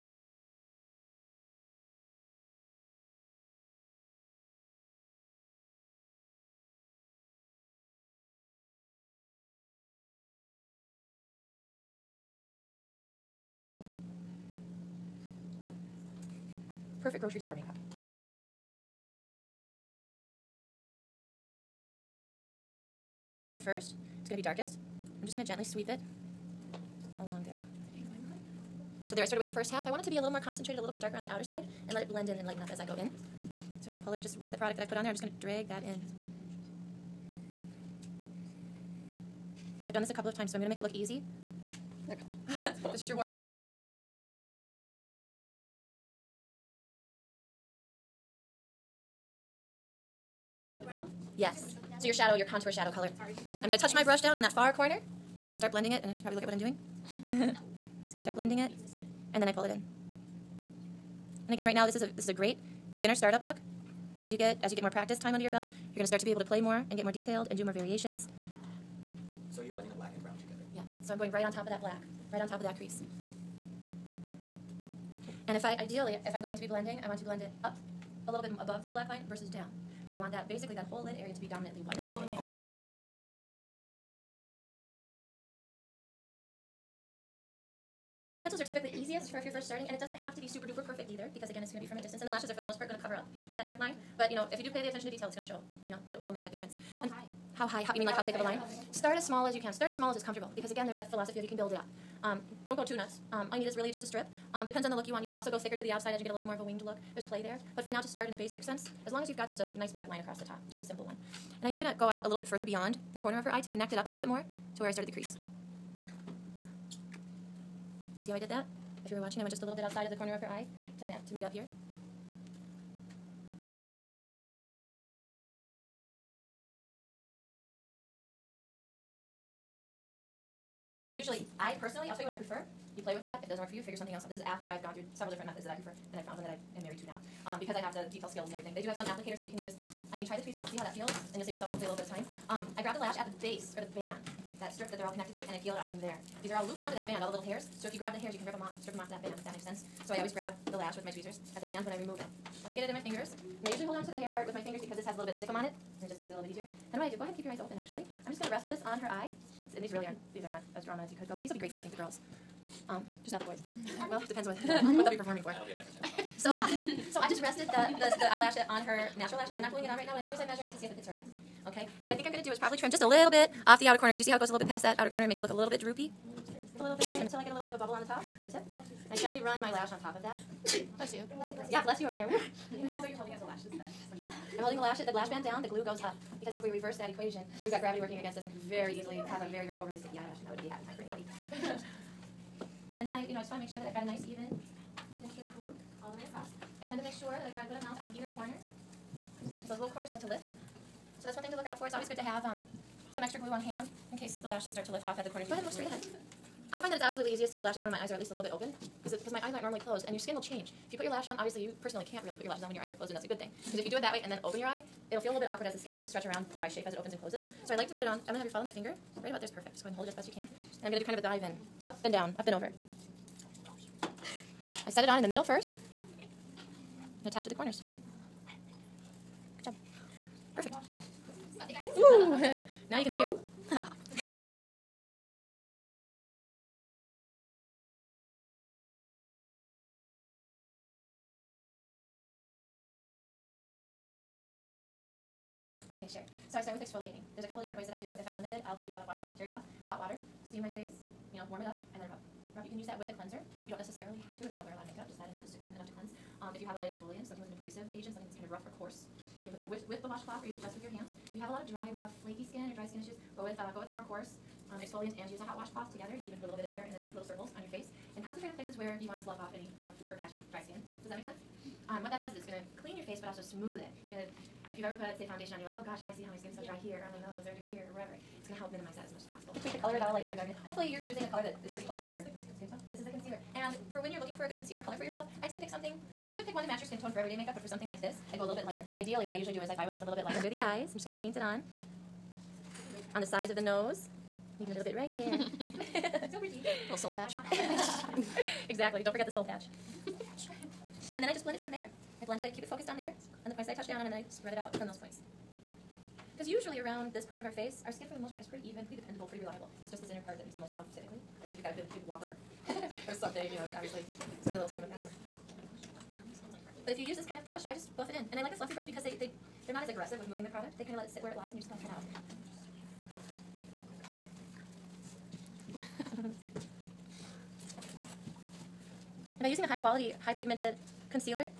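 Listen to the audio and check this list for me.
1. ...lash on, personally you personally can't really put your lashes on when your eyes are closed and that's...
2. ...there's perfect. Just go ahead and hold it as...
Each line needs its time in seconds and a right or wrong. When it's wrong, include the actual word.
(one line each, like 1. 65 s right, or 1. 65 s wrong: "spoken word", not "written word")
1. 211 s wrong: "obviously", not "personally"
2. 219 s right.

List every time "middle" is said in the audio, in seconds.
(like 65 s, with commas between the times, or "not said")
225 s.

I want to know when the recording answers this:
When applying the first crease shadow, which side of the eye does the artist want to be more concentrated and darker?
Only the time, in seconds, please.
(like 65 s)
31 s.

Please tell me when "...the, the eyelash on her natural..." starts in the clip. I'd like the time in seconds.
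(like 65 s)
167 s.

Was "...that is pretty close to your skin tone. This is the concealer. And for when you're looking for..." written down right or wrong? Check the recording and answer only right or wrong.
right.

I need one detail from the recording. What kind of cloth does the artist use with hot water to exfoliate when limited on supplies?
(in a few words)
Terry cloth.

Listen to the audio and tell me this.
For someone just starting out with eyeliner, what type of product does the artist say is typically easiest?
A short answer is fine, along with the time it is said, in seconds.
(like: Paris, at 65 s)
Pencils, at 88 s.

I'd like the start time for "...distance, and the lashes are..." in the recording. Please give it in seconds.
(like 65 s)
92 s.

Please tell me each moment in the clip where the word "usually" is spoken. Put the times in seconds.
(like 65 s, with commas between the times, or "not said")
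131 s, 153 s, 289 s, 306 s.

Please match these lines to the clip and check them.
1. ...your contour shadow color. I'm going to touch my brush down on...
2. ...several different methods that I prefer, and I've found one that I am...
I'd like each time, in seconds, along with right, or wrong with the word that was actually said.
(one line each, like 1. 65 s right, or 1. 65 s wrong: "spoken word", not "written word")
1. 52 s right
2. 135 s right.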